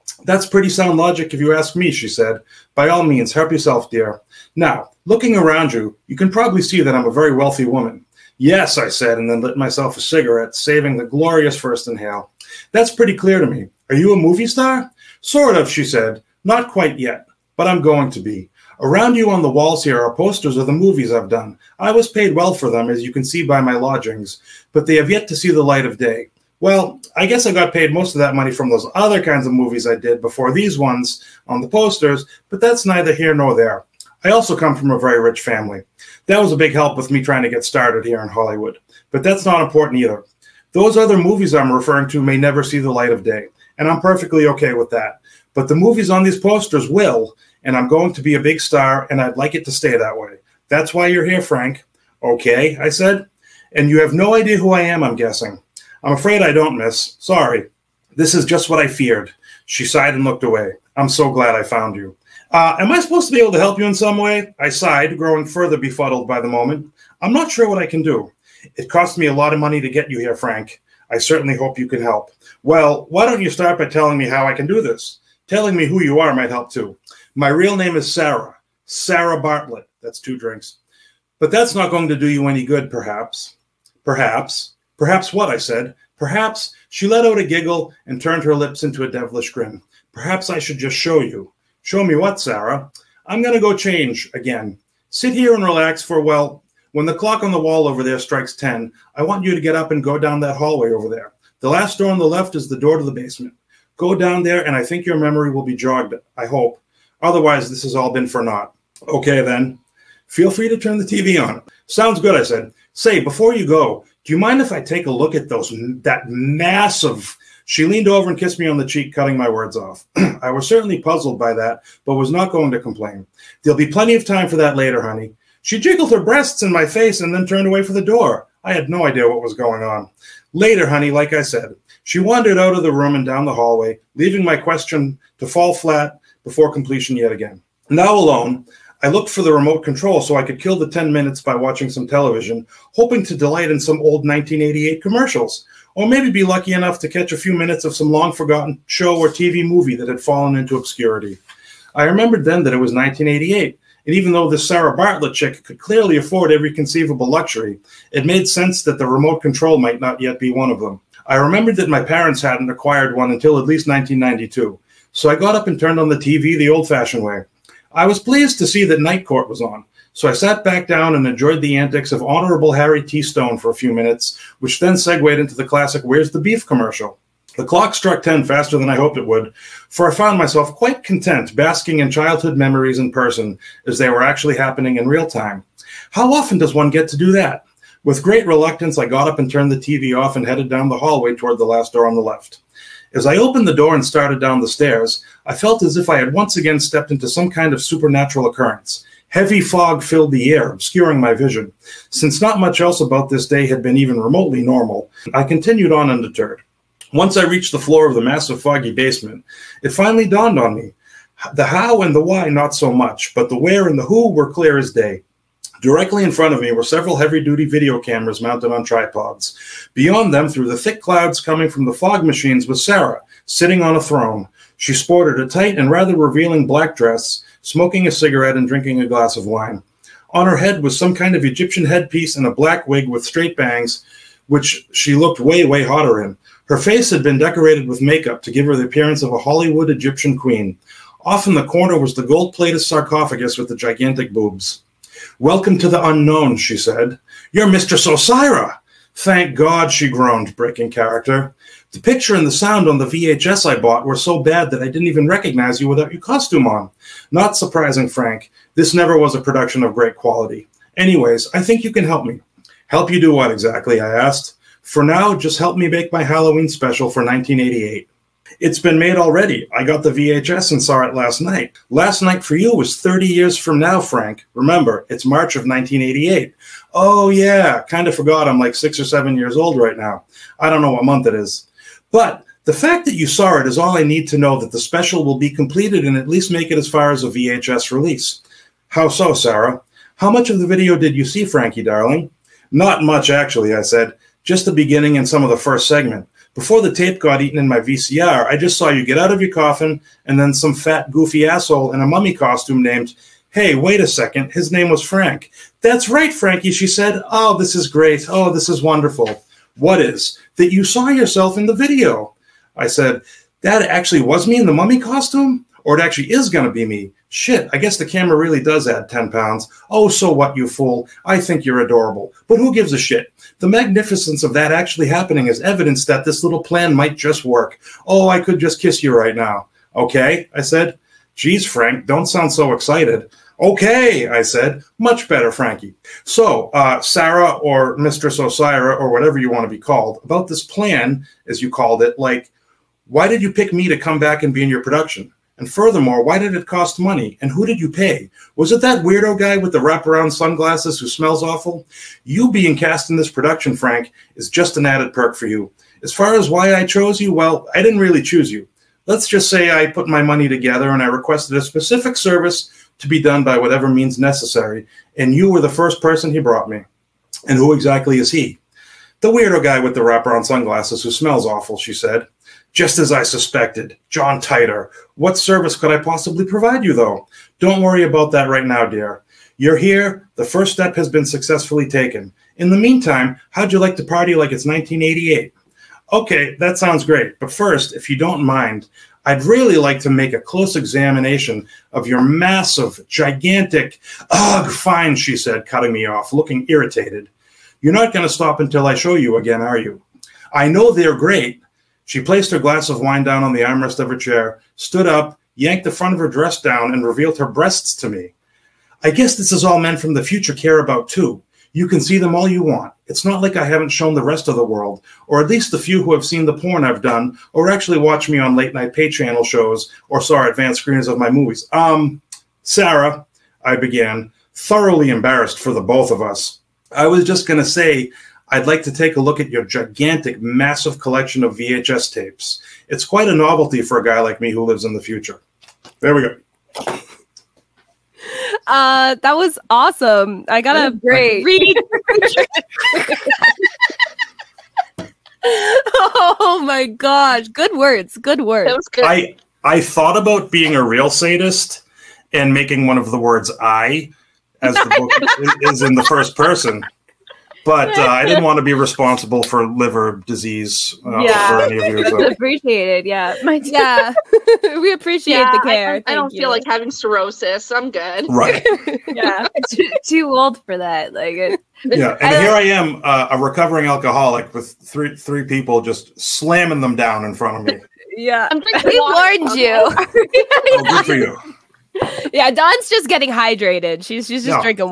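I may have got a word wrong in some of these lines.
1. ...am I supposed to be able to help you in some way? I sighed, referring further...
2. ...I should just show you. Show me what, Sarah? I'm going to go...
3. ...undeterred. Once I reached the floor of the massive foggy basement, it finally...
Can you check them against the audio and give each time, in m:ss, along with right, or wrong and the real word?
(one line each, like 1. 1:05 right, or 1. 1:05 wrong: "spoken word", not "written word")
1. 1:02 wrong: "growing", not "referring"
2. 1:30 right
3. 3:26 right.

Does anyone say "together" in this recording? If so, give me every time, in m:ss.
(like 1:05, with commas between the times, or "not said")
6:00.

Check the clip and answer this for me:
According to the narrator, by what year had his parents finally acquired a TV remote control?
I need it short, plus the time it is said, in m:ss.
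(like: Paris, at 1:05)
1992, at 2:43.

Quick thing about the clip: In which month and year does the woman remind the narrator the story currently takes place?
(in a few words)
March of 1988.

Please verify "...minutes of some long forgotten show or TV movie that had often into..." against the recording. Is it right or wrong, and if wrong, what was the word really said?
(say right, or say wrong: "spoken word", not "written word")
wrong: "fallen", not "often".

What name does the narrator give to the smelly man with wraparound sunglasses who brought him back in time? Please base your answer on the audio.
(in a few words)
John Titor.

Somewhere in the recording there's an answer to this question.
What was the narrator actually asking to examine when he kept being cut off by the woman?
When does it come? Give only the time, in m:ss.
7:11.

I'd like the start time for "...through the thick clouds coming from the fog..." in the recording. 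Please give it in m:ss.
3:40.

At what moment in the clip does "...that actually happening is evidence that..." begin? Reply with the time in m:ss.
5:24.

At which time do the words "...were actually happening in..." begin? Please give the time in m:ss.
3:04.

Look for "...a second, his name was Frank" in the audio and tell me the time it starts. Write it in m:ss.
5:04.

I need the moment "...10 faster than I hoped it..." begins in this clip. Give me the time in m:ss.
2:58.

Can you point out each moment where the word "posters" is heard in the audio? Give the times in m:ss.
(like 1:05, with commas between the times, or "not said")
0:20, 0:31, 0:46.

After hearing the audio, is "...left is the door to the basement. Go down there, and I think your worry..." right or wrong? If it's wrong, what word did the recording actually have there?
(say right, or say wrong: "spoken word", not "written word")
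wrong: "memory", not "worry".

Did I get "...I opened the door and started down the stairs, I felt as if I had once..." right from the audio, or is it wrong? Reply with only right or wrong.
right.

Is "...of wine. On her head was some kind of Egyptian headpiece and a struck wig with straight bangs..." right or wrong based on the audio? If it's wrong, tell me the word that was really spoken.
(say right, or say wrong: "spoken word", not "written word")
wrong: "black", not "struck".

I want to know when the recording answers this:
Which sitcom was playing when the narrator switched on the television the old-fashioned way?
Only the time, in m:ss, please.
2:49.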